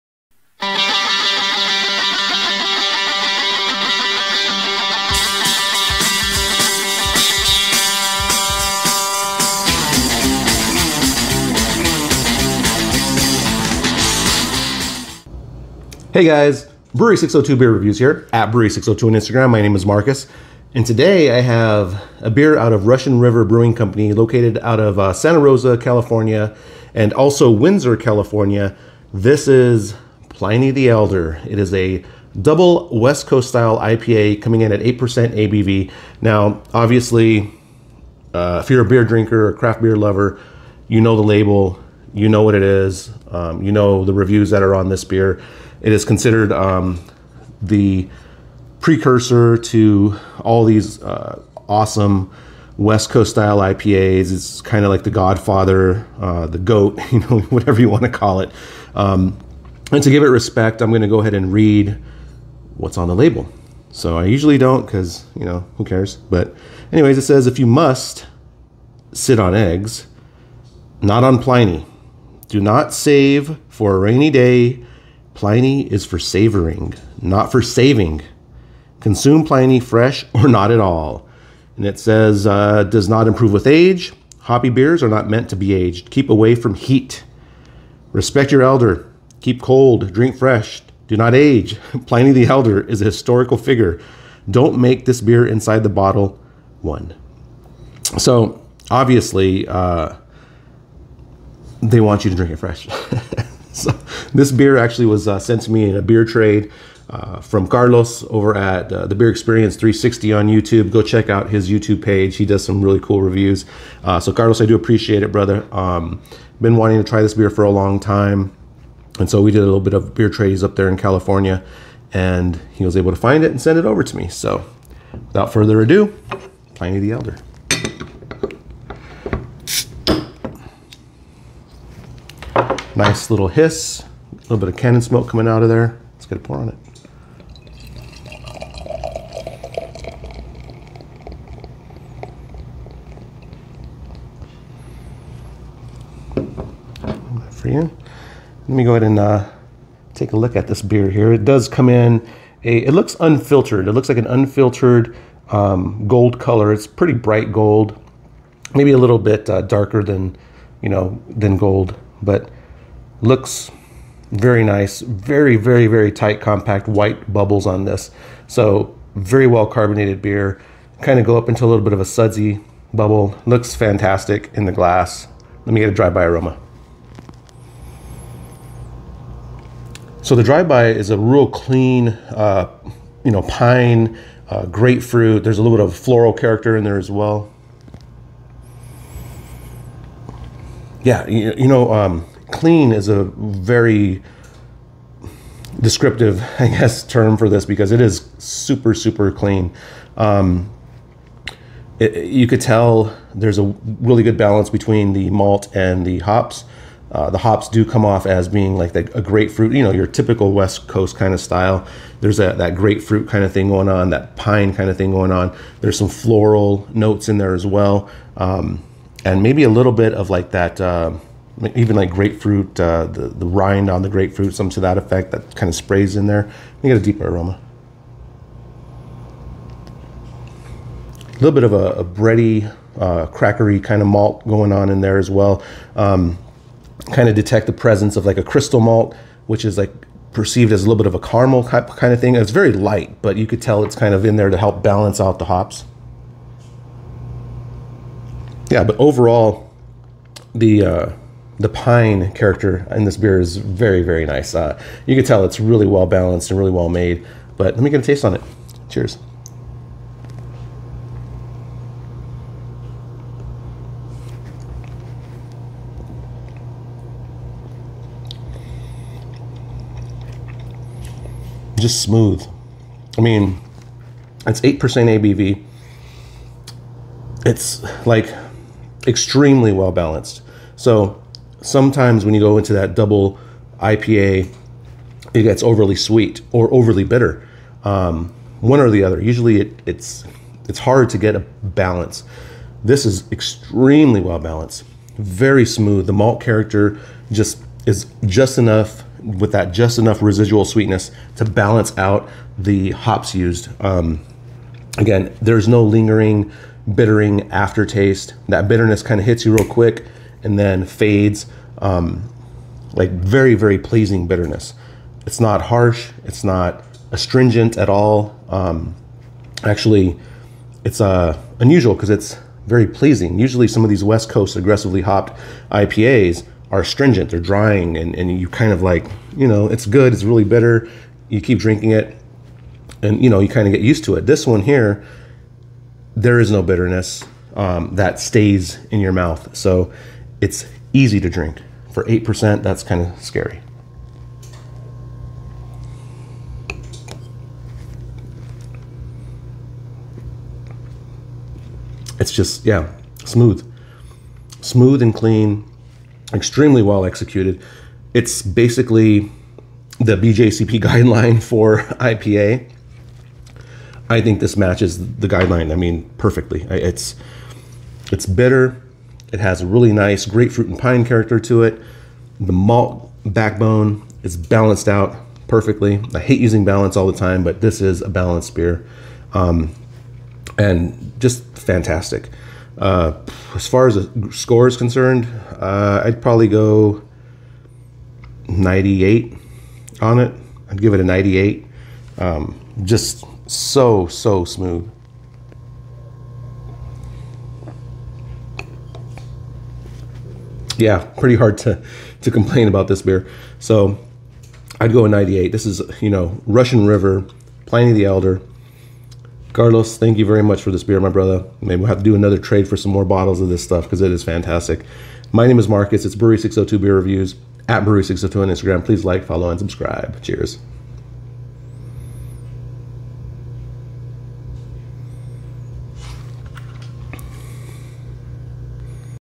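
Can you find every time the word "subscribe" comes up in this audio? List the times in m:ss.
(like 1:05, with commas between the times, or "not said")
6:59.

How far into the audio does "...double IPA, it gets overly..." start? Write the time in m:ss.
4:42.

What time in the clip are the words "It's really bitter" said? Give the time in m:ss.
5:30.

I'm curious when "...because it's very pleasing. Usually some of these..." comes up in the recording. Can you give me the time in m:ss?
5:21.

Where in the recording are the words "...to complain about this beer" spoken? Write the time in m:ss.
6:42.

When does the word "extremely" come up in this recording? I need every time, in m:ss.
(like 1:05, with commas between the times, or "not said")
4:39, 4:53, 5:56.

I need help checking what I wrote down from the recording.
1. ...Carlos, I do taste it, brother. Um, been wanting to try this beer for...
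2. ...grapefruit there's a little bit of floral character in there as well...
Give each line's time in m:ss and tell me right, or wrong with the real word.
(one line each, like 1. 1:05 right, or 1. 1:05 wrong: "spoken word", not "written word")
1. 1:54 wrong: "appreciate", not "taste"
2. 3:04 right.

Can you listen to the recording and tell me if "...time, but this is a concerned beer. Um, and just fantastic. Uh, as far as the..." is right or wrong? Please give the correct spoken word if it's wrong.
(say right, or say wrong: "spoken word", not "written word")
wrong: "balanced", not "concerned".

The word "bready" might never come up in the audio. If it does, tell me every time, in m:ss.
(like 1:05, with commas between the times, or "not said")
3:52.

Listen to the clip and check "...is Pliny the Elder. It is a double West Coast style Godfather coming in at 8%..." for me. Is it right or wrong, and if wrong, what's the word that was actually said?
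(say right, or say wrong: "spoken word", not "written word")
wrong: "IPA", not "Godfather".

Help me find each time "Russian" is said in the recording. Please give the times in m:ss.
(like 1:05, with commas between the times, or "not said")
0:22, 6:46.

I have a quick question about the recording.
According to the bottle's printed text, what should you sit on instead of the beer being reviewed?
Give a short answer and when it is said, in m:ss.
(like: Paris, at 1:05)
Eggs, at 1:09.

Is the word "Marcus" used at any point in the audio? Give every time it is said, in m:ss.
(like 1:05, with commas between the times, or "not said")
0:19, 6:55.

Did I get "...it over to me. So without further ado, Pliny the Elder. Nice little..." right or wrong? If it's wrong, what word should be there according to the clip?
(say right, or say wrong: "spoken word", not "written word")
right.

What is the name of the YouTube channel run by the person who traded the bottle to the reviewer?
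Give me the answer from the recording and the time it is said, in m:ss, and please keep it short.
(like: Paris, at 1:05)
The Beer Experience 360, at 1:49.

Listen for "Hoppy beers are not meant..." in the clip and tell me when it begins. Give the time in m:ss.
1:24.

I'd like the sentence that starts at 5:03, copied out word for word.
Um, again, there's no lingering bittering aftertaste.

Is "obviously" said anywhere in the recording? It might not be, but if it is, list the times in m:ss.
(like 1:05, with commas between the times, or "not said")
0:36, 1:38.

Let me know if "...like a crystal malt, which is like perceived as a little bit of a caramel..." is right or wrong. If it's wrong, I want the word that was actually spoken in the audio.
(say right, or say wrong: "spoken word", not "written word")
right.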